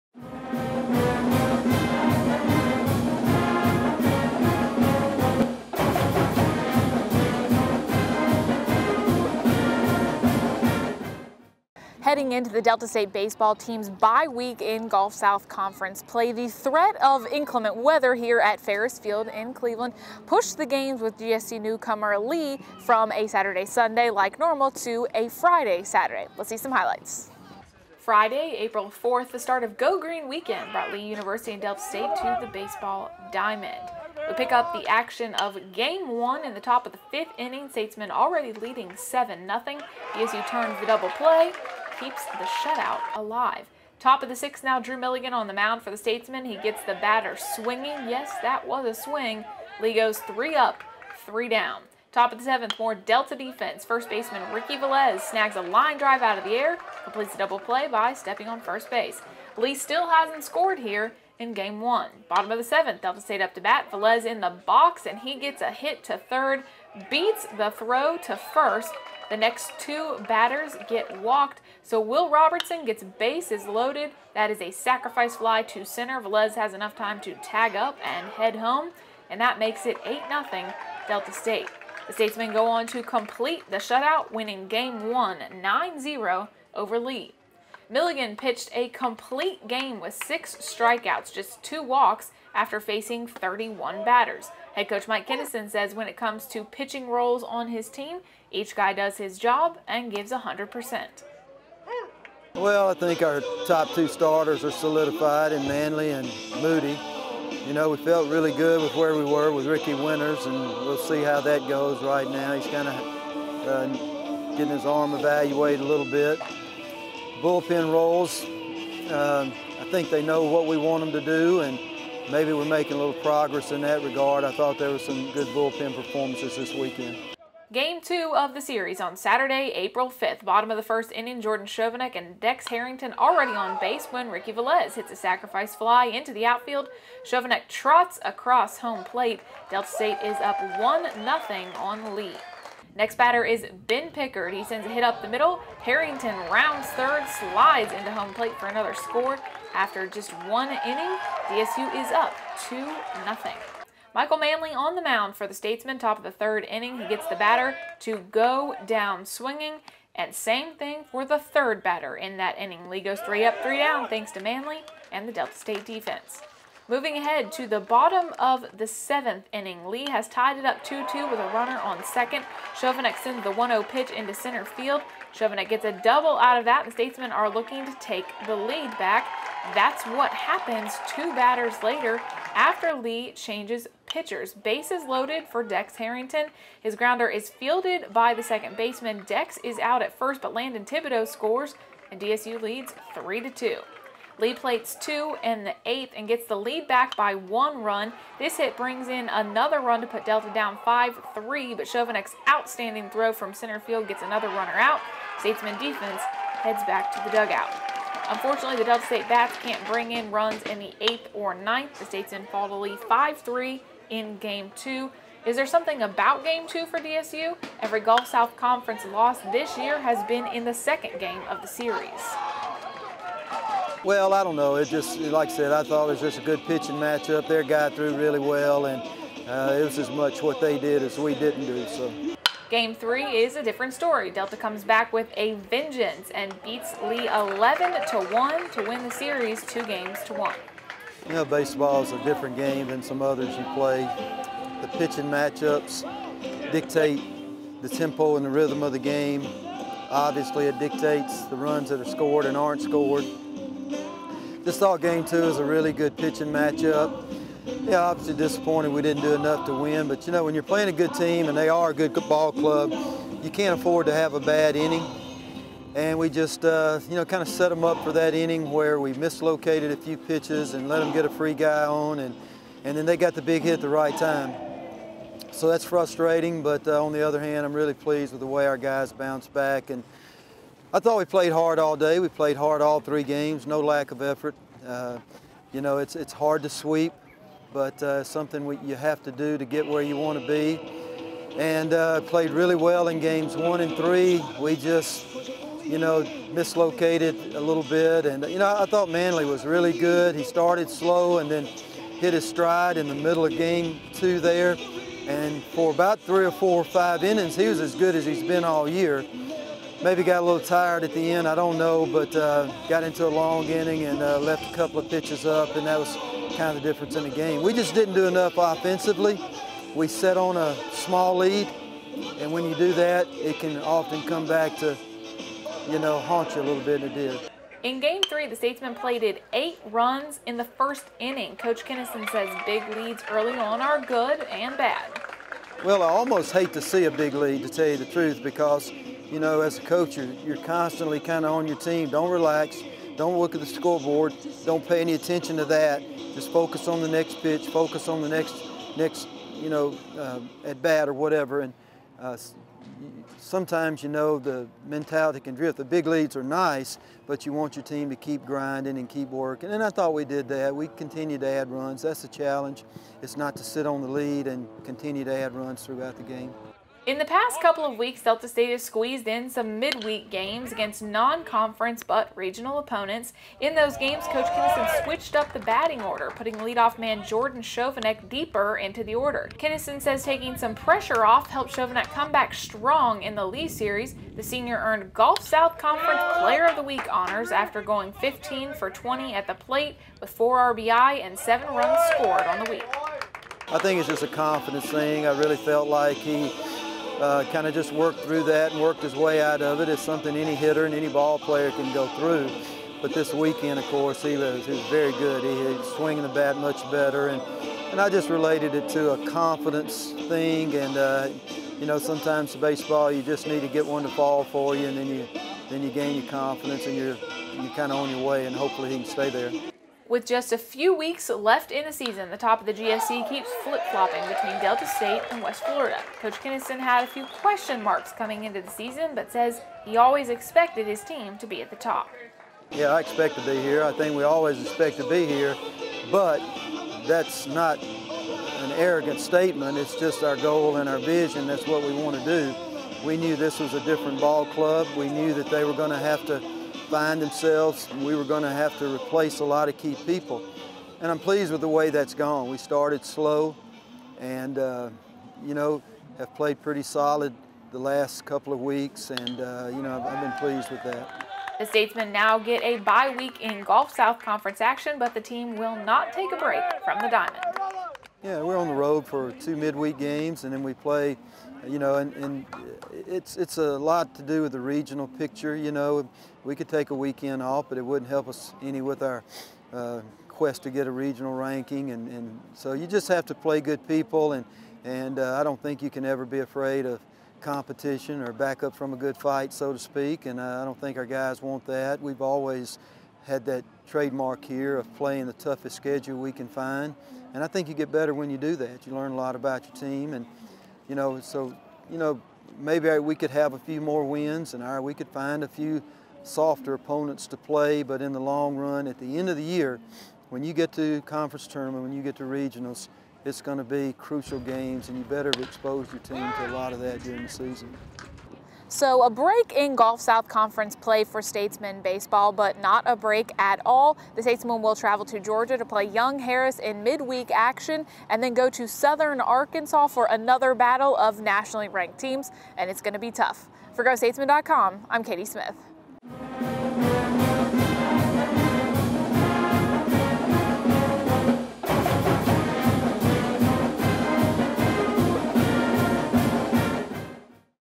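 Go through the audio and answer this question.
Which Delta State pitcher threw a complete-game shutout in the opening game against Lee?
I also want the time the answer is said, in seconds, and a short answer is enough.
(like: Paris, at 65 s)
Drew Milligan, at 44 s.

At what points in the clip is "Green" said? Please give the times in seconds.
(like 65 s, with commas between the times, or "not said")
29 s.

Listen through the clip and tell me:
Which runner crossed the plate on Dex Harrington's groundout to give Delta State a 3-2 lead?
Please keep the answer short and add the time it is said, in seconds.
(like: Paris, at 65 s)
Landon Thibodeau, at 190 s.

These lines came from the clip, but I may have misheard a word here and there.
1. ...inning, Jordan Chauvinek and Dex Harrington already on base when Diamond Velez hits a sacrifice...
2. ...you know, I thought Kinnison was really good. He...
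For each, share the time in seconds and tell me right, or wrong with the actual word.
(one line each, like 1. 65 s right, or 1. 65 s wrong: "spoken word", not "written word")
1. 131 s wrong: "Ricky", not "Diamond"
2. 298 s wrong: "Manley", not "Kinnison".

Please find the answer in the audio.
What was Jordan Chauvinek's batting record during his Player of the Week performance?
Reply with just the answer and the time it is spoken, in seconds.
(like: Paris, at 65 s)
15 for 20, at 388 s.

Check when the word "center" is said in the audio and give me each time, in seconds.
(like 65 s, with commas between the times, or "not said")
75 s, 174 s, 203 s.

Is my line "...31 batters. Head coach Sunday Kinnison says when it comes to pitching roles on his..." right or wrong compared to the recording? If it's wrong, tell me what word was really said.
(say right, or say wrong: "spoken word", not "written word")
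wrong: "Mike", not "Sunday".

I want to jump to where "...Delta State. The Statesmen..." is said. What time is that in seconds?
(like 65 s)
81 s.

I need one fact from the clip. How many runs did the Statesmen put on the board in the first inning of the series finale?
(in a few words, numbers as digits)
8.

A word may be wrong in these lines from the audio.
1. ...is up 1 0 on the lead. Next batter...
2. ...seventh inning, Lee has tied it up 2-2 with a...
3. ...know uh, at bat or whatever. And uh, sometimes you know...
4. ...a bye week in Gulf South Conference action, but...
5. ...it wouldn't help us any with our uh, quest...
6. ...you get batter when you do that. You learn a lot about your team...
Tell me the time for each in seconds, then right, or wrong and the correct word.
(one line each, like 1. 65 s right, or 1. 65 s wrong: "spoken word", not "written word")
1. 140 s right
2. 168 s right
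3. 349 s right
4. 462 s right
5. 477 s right
6. 497 s wrong: "better", not "batter".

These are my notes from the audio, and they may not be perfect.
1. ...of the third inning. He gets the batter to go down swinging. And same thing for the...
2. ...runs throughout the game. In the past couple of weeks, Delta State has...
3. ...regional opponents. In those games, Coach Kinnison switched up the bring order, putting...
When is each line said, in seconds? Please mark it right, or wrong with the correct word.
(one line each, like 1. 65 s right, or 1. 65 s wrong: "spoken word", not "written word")
1. 156 s right
2. 365 s right
3. 372 s wrong: "batting", not "bring".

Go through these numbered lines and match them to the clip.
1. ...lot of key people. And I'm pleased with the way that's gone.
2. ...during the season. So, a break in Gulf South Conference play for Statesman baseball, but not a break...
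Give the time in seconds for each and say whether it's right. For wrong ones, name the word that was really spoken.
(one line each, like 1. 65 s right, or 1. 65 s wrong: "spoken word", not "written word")
1. 449 s right
2. 517 s right.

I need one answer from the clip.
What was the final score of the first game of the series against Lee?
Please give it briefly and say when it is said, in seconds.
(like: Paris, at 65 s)
9-0, at 85 s.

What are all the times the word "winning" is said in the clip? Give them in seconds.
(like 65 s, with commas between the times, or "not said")
84 s.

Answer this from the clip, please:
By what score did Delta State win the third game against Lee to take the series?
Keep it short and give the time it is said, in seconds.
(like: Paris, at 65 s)
11-1, at 237 s.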